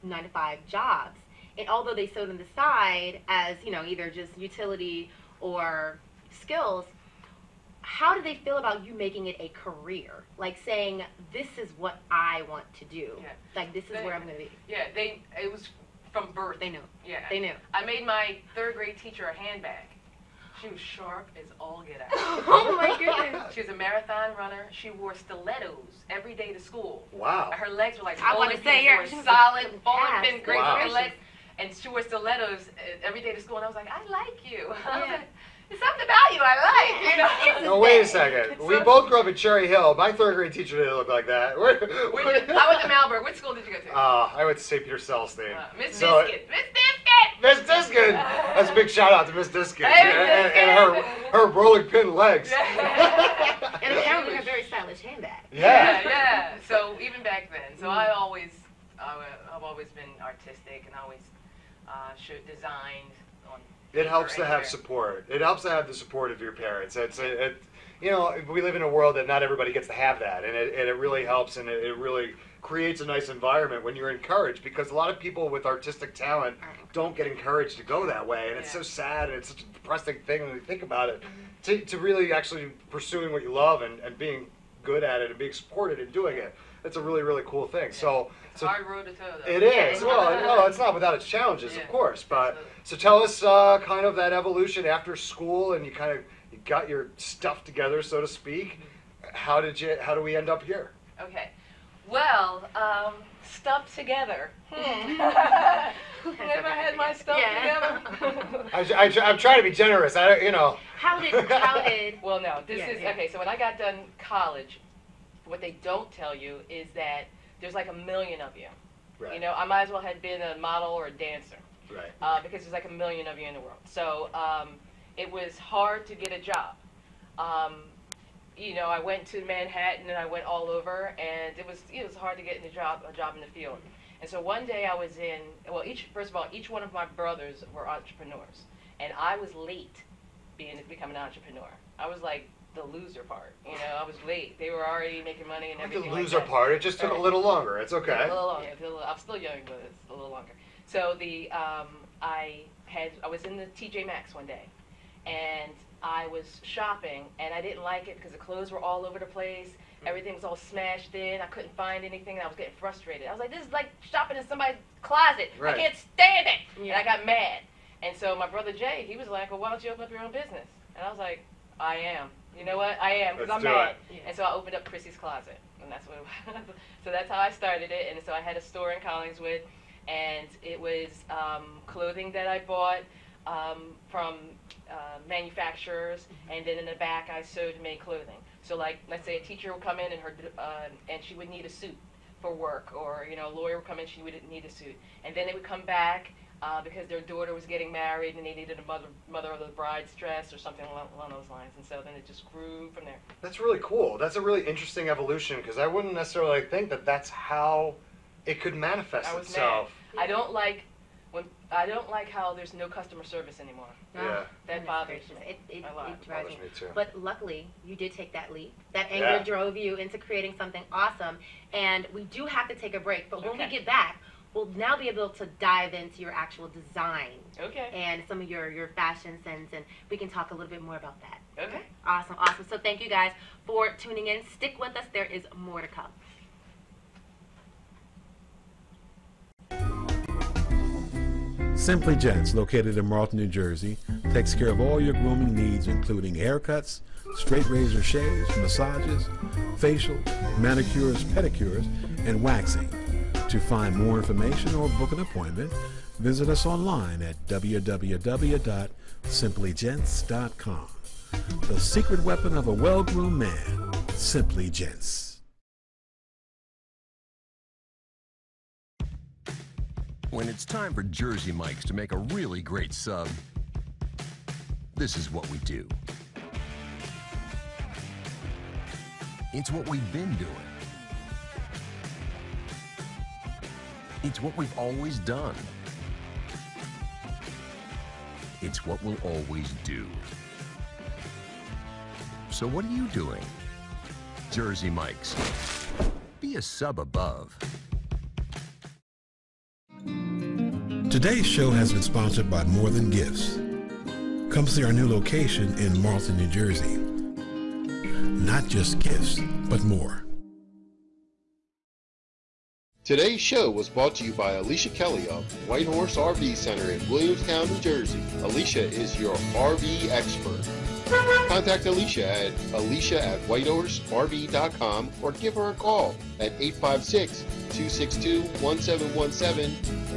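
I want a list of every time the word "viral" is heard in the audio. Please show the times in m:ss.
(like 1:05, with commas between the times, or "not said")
not said.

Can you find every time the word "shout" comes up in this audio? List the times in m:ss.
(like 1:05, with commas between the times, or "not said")
0:48.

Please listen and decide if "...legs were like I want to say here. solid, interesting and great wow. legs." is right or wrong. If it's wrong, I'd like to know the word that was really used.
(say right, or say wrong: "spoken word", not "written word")
wrong: "bowling", not "interesting".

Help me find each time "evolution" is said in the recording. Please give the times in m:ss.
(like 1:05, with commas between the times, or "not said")
1:34, 3:25.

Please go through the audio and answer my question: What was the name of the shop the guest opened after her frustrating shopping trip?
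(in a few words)
Chrissy's closet.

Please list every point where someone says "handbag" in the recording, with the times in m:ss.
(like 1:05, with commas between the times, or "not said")
0:19, 0:55.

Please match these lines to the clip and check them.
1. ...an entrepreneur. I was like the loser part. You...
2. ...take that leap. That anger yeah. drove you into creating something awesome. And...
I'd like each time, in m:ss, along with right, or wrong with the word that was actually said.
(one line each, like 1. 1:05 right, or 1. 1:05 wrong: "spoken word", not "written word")
1. 2:21 right
2. 3:38 right.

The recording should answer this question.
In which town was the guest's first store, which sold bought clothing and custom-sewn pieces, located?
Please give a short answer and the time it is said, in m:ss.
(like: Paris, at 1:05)
Collingswood, at 2:58.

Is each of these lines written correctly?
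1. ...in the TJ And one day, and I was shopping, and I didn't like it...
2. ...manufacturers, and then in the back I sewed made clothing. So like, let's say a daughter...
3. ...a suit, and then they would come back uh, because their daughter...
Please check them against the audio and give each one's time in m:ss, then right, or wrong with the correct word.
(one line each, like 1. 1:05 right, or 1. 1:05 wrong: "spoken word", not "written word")
1. 2:33 wrong: "Maxx", not "And"
2. 3:05 wrong: "teacher", not "daughter"
3. 3:14 right.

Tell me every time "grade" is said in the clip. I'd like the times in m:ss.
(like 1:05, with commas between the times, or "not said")
0:18, 0:40.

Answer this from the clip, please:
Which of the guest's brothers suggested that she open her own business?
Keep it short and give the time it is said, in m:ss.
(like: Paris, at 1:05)
Jay, at 2:48.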